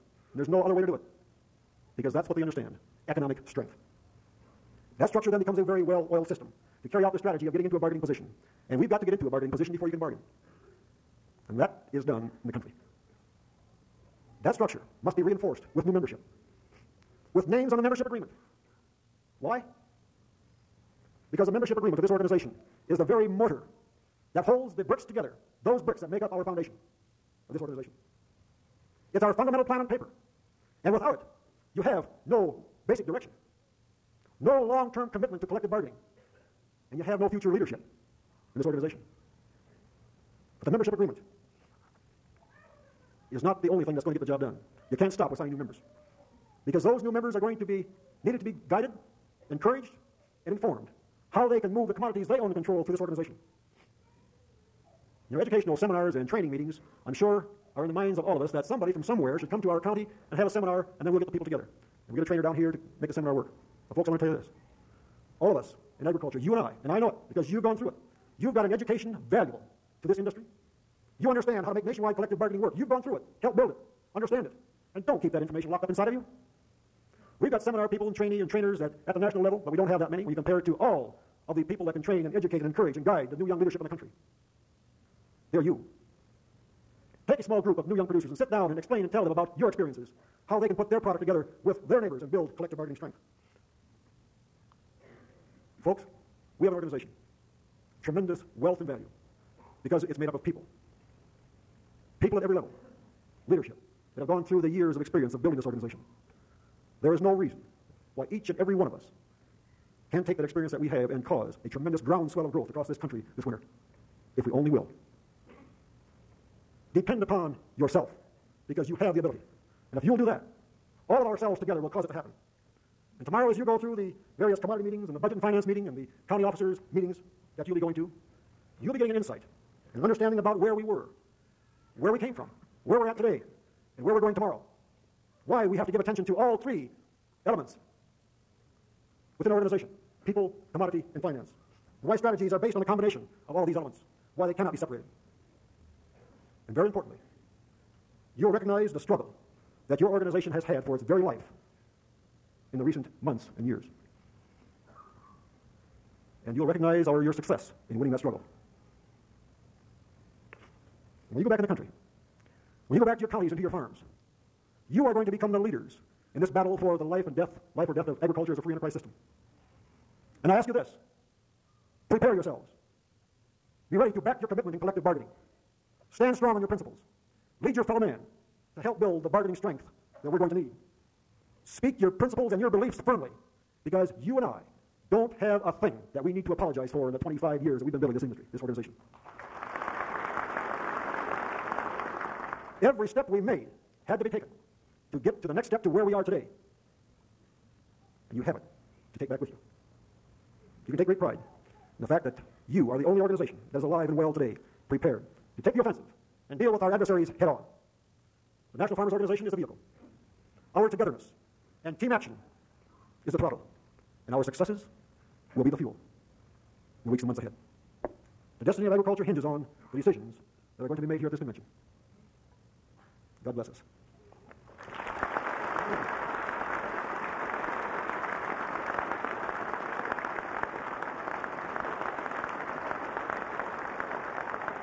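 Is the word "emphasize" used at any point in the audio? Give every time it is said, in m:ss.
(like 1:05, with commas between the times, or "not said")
not said.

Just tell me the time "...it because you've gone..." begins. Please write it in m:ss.
1:07.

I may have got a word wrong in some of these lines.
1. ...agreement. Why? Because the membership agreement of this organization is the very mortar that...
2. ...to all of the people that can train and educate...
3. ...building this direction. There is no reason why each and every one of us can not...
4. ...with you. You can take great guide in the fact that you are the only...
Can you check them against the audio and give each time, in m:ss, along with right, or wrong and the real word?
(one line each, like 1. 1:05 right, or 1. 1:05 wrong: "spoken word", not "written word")
1. 0:18 right
2. 1:20 right
3. 1:45 wrong: "organization", not "direction"
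4. 3:19 wrong: "pride", not "guide".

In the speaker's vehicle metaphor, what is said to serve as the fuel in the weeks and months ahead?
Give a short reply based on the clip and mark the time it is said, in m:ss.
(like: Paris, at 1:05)
Our successes, at 3:34.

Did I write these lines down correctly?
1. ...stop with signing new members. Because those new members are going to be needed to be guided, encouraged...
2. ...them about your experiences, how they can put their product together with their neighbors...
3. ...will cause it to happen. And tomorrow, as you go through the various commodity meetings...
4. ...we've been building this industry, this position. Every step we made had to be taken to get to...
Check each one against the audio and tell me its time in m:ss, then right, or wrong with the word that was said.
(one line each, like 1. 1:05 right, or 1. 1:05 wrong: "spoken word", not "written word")
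1. 0:45 right
2. 1:29 right
3. 2:01 right
4. 3:07 wrong: "organization", not "position".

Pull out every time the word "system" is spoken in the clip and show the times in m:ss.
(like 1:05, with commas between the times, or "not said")
0:06, 2:48.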